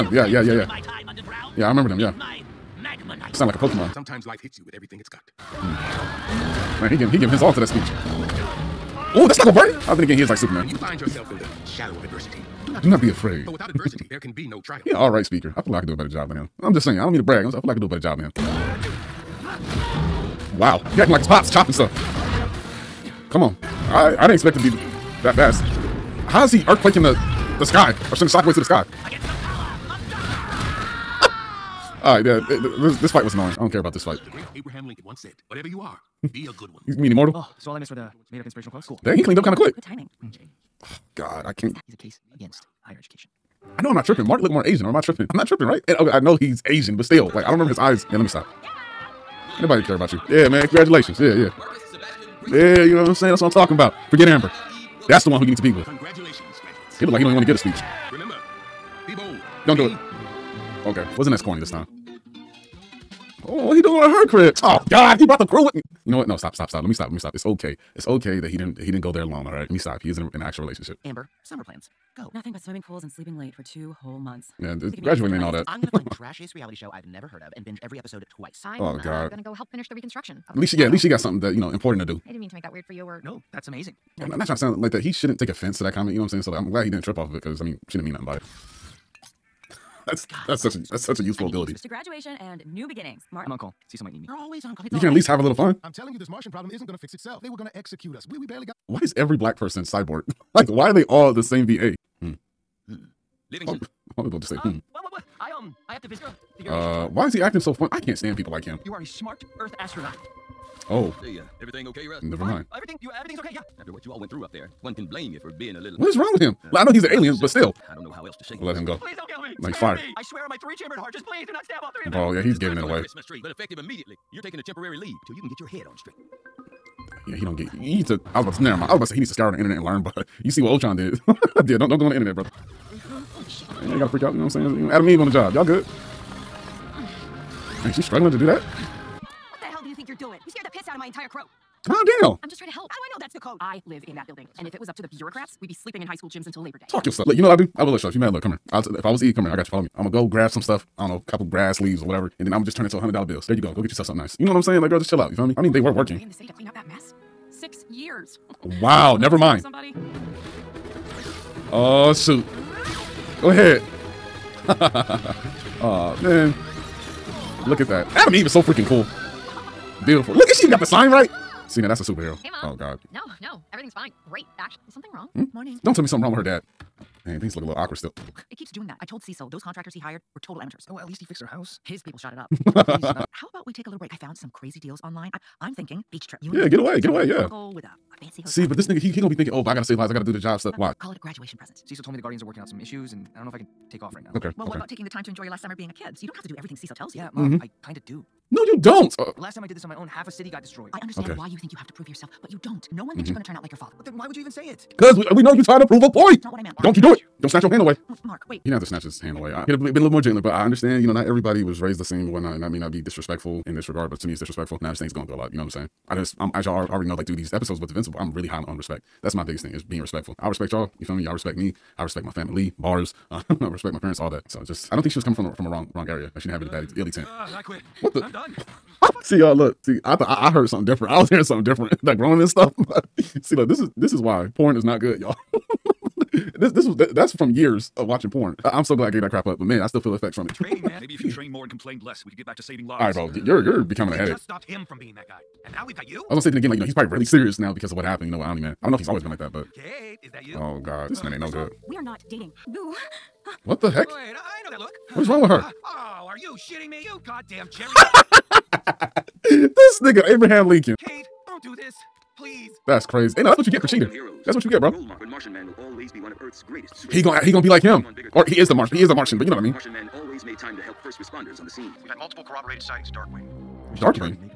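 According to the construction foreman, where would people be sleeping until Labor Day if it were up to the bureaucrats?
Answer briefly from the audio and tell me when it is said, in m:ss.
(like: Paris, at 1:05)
high school gyms, at 2:26.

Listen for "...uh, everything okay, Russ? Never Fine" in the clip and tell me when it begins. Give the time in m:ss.
1:51.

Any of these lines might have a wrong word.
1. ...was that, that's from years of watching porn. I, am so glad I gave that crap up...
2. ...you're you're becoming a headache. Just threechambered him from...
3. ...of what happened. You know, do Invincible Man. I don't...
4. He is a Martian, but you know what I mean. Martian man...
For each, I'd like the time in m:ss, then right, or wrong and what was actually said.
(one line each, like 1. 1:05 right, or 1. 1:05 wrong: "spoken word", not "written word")
1. 3:56 right
2. 4:03 wrong: "stopped", not "threechambered"
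3. 4:07 wrong: "Omni", not "Invincible"
4. 4:28 right.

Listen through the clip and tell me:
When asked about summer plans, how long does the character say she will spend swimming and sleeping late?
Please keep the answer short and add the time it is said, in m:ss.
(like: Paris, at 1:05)
2 months, at 1:13.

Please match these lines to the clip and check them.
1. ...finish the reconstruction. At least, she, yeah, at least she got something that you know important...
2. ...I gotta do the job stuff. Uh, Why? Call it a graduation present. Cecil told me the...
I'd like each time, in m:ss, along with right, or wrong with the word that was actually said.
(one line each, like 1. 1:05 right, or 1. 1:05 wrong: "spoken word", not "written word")
1. 1:19 right
2. 3:10 right.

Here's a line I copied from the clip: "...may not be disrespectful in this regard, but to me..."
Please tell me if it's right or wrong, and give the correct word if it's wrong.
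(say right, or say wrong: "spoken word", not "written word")
right.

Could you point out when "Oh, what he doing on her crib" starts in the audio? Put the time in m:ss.
1:03.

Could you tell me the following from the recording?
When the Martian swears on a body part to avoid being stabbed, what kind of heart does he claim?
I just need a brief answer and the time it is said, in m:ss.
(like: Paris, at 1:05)
three-chambered, at 2:00.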